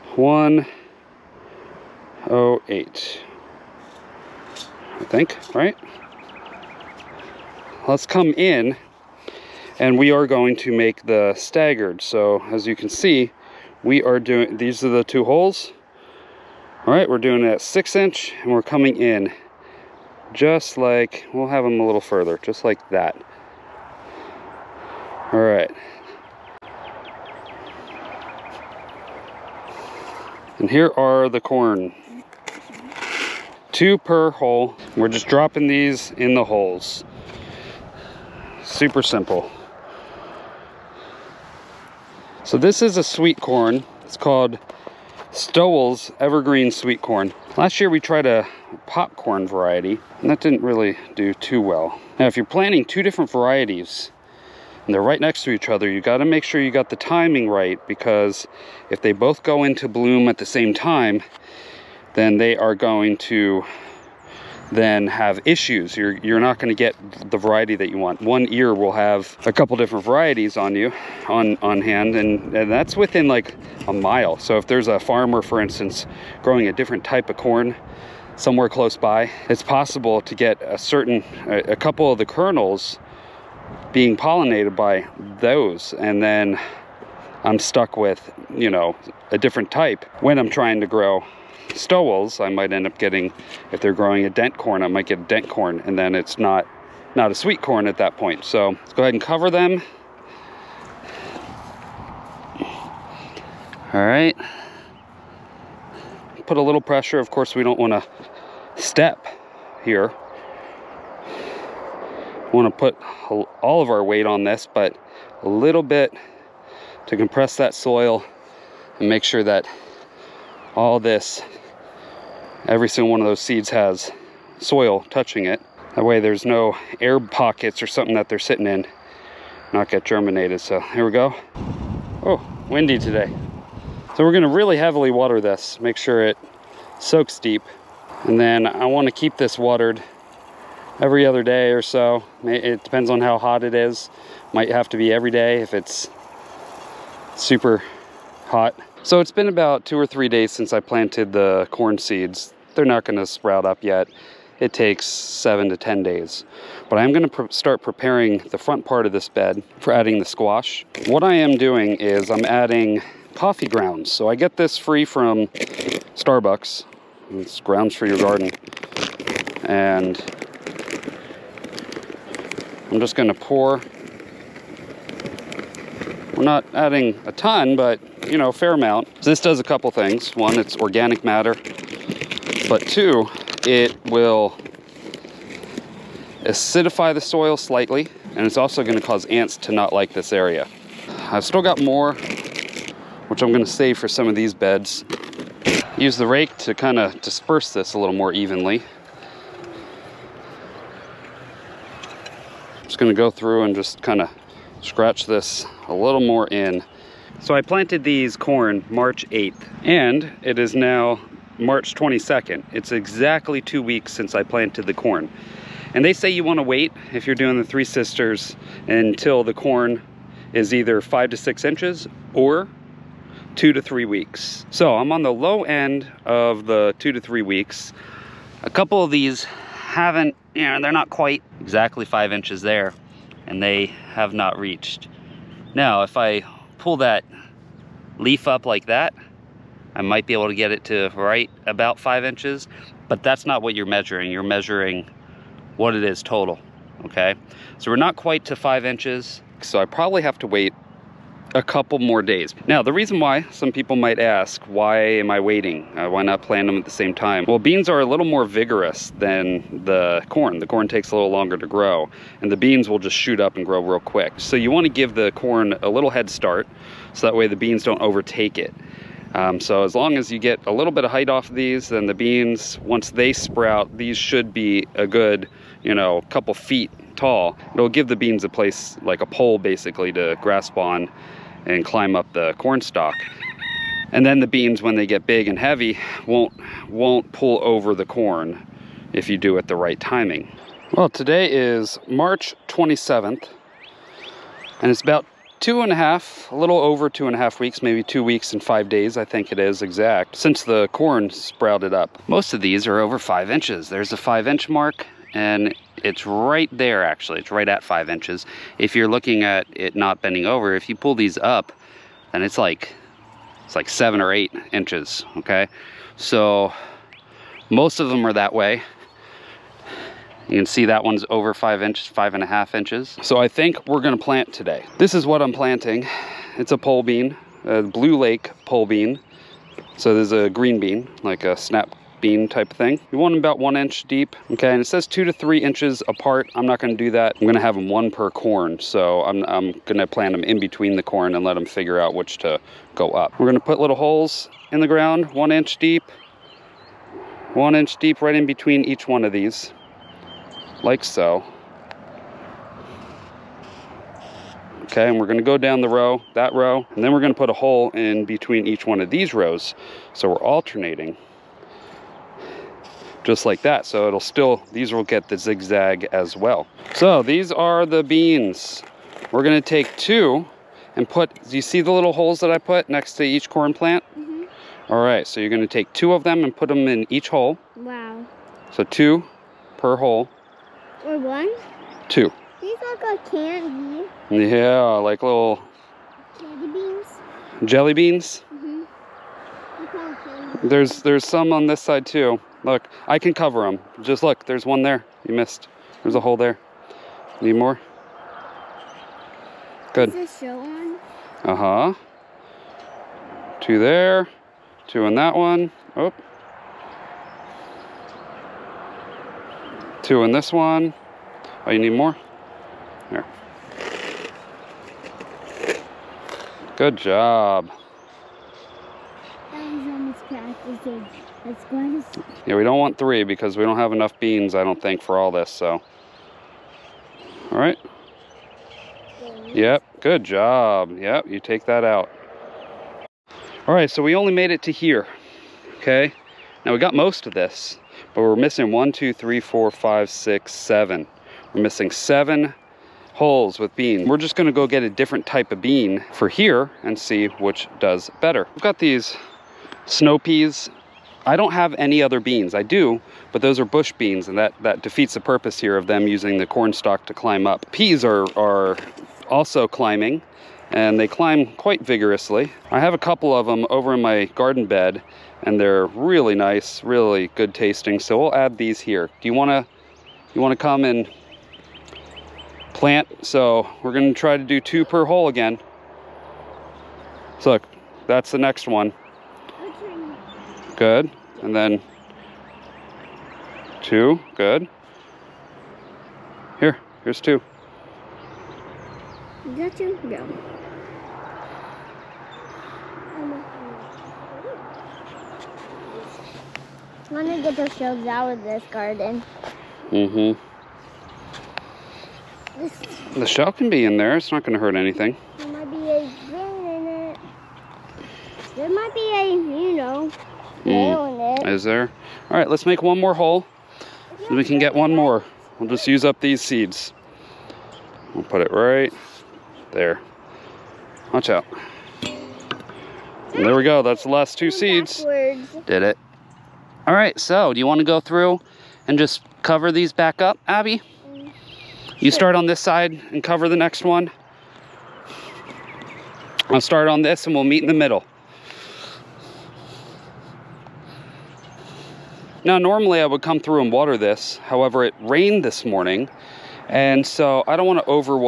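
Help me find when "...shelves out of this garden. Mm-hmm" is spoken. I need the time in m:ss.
8:17.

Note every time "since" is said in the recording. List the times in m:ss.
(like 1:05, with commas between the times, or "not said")
2:30, 3:34, 5:00.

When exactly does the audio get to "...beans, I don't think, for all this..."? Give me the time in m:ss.
7:04.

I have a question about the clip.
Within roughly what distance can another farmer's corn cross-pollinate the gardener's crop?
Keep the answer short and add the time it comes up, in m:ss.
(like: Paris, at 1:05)
a mile, at 1:13.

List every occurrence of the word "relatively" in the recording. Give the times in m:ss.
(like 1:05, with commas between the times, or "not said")
not said.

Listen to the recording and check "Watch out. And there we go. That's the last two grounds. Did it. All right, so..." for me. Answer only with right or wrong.
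wrong.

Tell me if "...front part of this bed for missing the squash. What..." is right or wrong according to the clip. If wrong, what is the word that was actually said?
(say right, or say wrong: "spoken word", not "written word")
wrong: "adding", not "missing".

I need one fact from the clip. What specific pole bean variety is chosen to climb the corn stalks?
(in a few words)
Blue Lake.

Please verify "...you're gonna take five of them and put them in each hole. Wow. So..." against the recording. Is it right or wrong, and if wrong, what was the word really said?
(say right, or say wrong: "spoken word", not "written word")
wrong: "two", not "five".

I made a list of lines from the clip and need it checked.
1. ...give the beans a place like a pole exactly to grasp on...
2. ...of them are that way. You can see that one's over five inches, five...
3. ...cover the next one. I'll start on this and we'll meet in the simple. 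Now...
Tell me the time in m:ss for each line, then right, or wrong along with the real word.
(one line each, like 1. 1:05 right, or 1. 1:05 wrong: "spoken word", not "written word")
1. 4:37 wrong: "basically", not "exactly"
2. 5:17 right
3. 8:53 wrong: "middle", not "simple".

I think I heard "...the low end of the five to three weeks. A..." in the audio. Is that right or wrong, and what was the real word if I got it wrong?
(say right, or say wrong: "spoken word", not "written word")
wrong: "two", not "five".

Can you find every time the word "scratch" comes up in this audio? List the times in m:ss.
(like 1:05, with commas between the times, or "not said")
3:24.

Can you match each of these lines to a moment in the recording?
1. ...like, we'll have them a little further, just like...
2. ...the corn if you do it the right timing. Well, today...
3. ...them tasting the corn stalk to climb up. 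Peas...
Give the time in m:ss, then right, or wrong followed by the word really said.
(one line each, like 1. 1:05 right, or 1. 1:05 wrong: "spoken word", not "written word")
1. 0:20 right
2. 4:47 right
3. 7:35 wrong: "using", not "tasting".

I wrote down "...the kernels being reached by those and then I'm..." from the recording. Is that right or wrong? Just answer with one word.
wrong.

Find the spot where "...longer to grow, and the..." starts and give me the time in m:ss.
4:21.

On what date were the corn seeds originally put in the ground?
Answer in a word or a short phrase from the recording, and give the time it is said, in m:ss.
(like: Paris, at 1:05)
March 8th, at 3:28.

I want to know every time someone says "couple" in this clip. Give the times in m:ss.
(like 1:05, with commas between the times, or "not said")
1:09, 1:21, 2:59, 3:48, 4:11, 4:36, 7:42.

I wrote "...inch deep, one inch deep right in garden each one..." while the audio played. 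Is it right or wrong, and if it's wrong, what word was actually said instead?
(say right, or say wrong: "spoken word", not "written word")
wrong: "between", not "garden".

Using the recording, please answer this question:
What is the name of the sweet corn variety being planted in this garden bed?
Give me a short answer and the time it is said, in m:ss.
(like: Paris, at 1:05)
Stowell's Evergreen, at 0:45.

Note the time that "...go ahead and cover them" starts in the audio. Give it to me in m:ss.
1:38.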